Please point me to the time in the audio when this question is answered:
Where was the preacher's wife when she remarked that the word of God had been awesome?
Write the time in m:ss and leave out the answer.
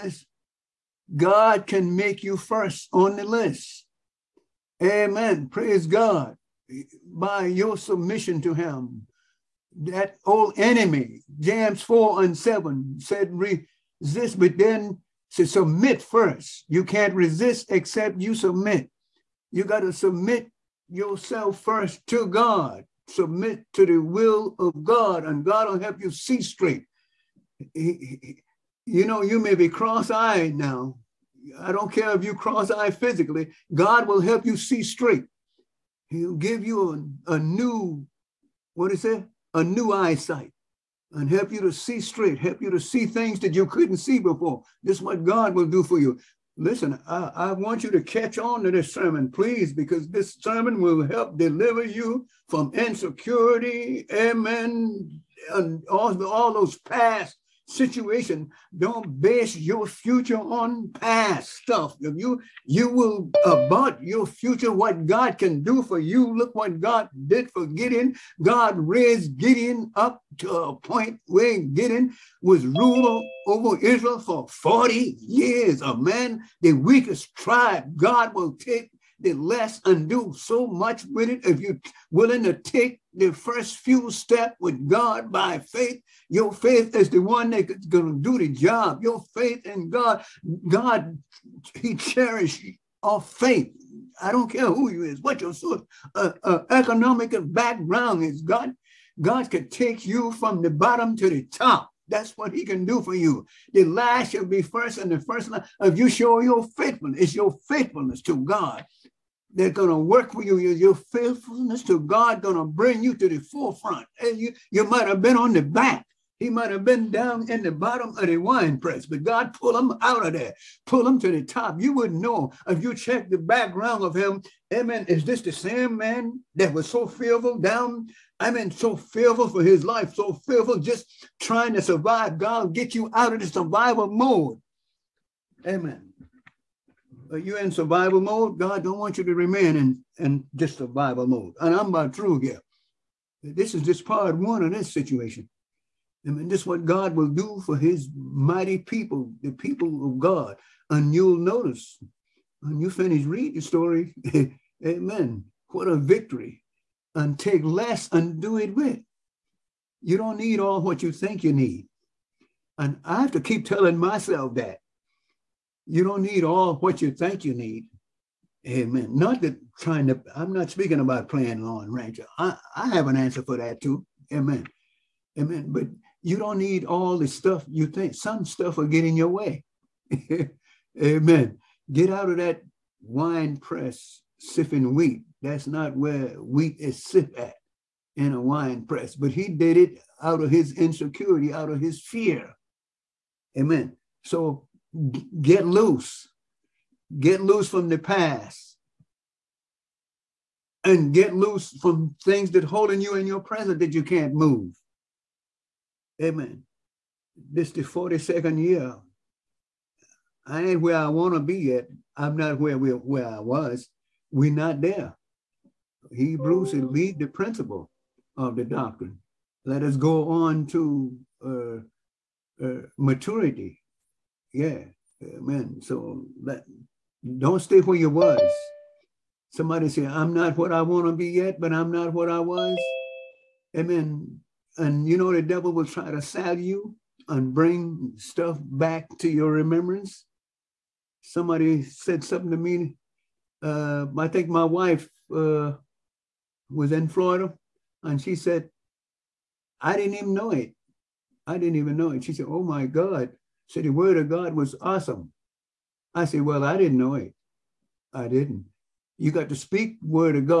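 4:07.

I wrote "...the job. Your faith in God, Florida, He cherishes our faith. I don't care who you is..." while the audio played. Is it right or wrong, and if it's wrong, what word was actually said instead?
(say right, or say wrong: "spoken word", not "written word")
wrong: "God", not "Florida".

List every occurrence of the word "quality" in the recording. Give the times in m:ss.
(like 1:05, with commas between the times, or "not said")
not said.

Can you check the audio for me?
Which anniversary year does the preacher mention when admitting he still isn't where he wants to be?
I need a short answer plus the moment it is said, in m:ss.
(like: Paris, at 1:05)
42nd, at 3:27.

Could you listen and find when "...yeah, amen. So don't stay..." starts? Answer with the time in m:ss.
3:44.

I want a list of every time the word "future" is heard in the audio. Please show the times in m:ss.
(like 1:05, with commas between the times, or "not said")
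0:59, 1:04.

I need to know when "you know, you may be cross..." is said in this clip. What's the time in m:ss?
0:27.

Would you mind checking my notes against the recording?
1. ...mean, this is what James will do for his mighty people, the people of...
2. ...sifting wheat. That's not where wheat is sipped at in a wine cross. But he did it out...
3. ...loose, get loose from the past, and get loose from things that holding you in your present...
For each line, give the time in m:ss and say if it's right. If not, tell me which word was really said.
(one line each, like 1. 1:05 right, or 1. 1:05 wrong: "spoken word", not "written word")
1. 2:26 wrong: "God", not "James"
2. 3:04 wrong: "press", not "cross"
3. 3:15 right.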